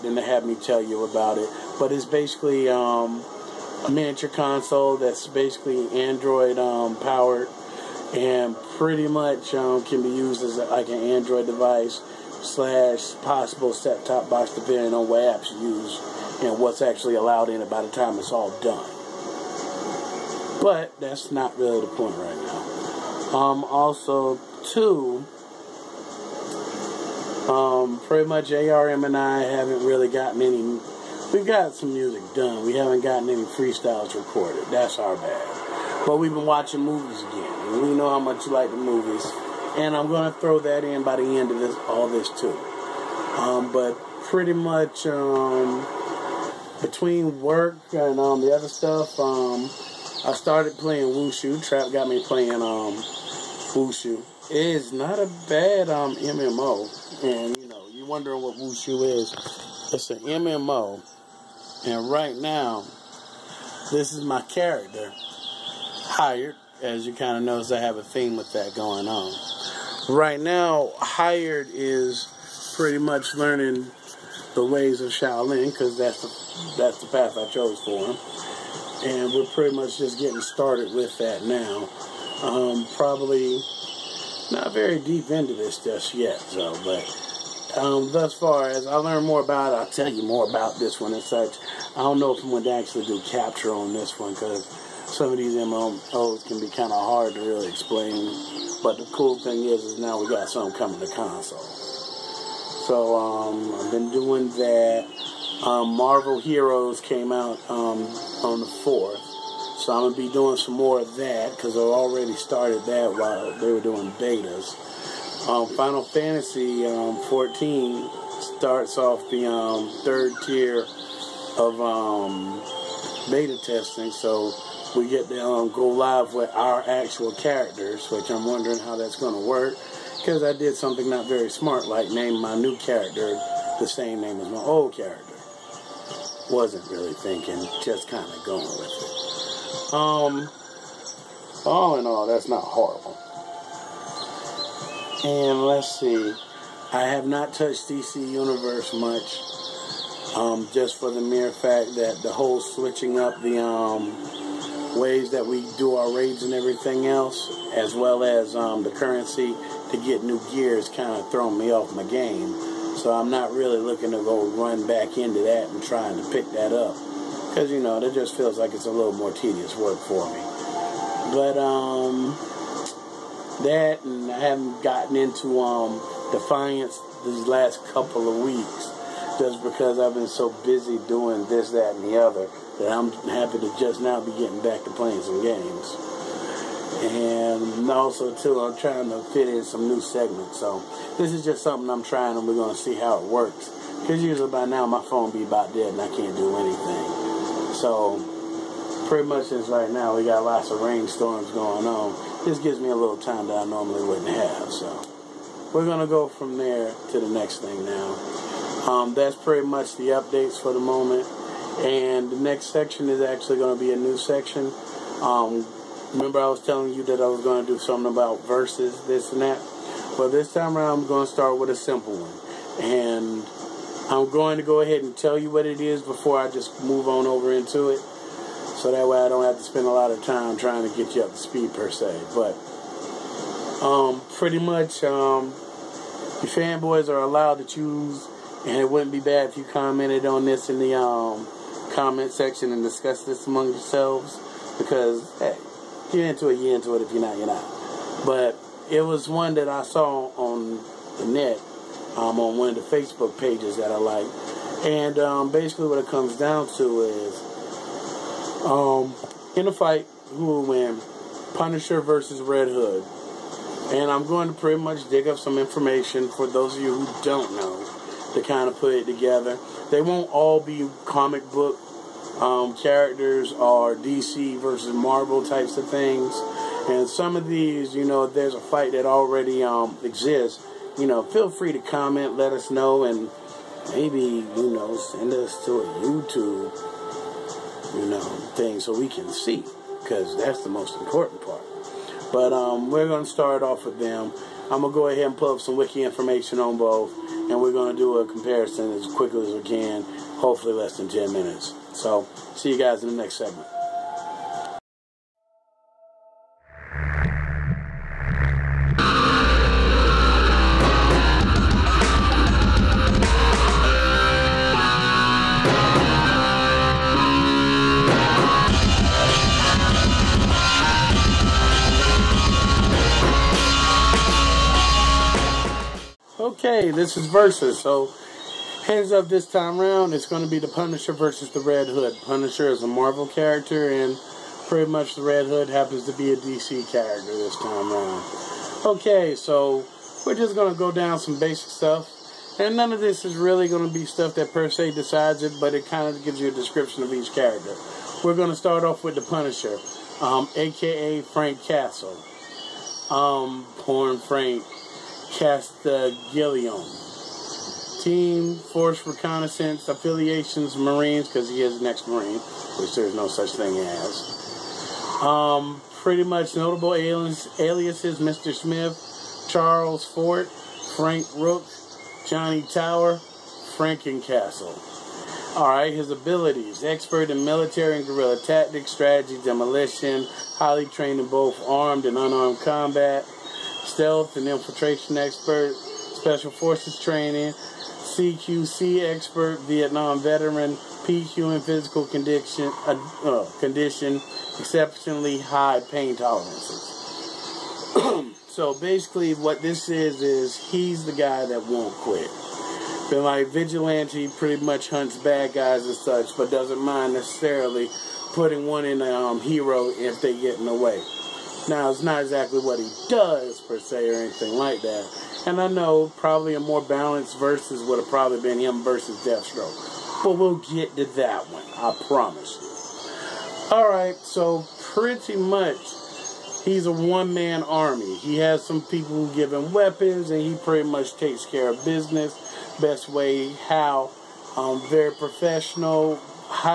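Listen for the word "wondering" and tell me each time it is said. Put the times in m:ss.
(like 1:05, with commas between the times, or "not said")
0:58, 2:08.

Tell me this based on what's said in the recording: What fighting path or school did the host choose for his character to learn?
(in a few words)
Shaolin.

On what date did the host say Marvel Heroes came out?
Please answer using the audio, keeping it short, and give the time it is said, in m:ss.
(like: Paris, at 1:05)
the 4th, at 1:48.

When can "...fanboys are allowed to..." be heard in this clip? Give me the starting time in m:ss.
3:56.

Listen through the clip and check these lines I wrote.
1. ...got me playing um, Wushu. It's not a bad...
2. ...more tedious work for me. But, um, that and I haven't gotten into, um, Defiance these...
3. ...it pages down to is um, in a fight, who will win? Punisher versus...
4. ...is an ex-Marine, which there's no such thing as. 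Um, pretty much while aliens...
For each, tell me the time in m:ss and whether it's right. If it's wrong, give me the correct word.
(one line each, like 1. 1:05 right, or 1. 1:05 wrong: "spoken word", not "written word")
1. 0:51 right
2. 2:49 right
3. 4:15 wrong: "comes", not "pages"
4. 6:01 wrong: "notable", not "while".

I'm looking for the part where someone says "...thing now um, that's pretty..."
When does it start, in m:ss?
3:27.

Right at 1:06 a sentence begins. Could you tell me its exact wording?
As you kind of notice, I have a theme with that going on.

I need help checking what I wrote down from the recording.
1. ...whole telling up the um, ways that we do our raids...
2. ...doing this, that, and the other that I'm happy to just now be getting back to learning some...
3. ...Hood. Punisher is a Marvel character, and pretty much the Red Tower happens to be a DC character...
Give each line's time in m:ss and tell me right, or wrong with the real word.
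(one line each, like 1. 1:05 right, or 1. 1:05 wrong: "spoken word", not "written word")
1. 2:32 wrong: "switching", not "telling"
2. 3:01 wrong: "playing", not "learning"
3. 5:31 wrong: "Hood", not "Tower".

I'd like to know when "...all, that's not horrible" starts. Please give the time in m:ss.
2:22.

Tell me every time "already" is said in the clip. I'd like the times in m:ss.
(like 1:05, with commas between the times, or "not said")
1:51, 4:39.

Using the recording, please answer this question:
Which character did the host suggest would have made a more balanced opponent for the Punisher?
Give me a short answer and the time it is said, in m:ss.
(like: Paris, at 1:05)
Deathstroke, at 6:59.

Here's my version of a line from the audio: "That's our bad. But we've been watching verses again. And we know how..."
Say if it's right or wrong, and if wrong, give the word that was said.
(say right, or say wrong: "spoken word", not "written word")
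wrong: "movies", not "verses".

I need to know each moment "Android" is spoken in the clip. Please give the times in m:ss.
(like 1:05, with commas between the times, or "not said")
0:06, 0:10.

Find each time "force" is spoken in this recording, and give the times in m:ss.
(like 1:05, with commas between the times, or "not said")
5:58, 6:26.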